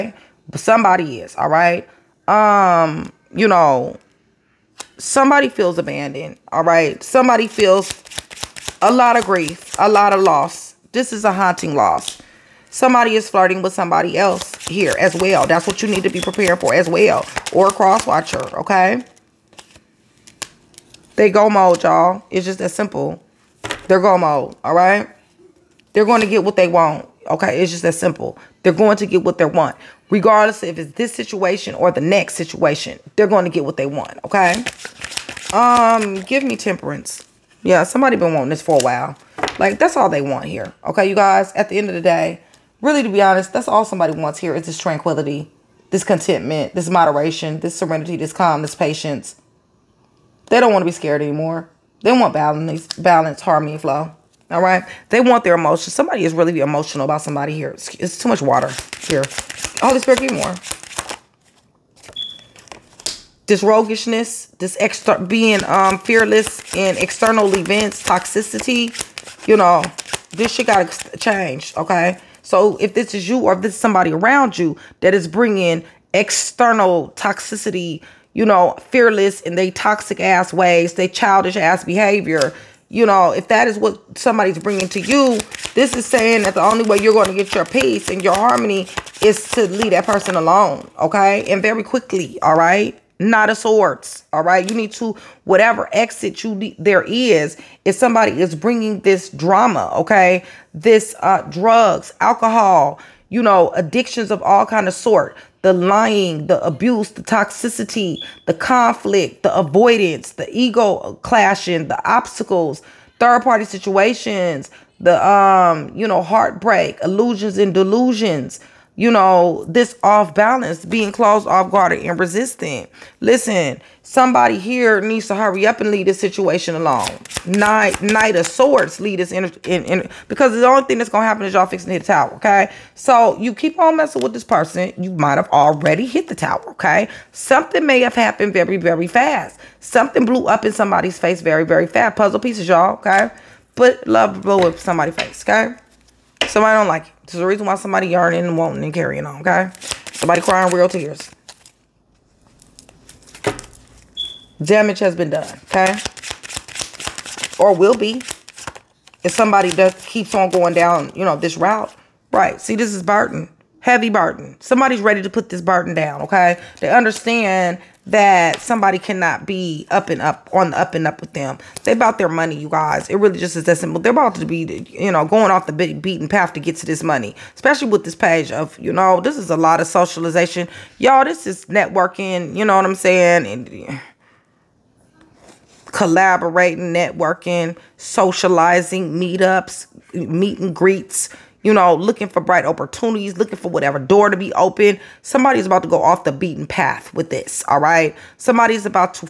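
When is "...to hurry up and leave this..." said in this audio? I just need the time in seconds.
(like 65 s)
125 s.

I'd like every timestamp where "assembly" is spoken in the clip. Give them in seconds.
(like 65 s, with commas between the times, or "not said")
not said.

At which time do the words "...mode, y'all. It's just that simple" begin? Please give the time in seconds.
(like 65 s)
21 s.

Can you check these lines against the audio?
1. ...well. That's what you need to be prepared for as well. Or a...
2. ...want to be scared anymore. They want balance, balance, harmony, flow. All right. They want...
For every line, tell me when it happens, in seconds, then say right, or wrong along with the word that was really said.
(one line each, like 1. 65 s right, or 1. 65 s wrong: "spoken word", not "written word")
1. 15 s right
2. 50 s right.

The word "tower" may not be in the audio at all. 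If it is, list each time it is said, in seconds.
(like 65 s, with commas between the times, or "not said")
132 s, 136 s.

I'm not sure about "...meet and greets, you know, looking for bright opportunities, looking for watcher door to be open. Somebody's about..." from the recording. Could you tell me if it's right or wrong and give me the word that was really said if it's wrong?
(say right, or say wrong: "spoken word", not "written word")
wrong: "whatever", not "watcher".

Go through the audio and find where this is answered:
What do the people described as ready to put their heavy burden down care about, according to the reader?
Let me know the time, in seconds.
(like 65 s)
172 s.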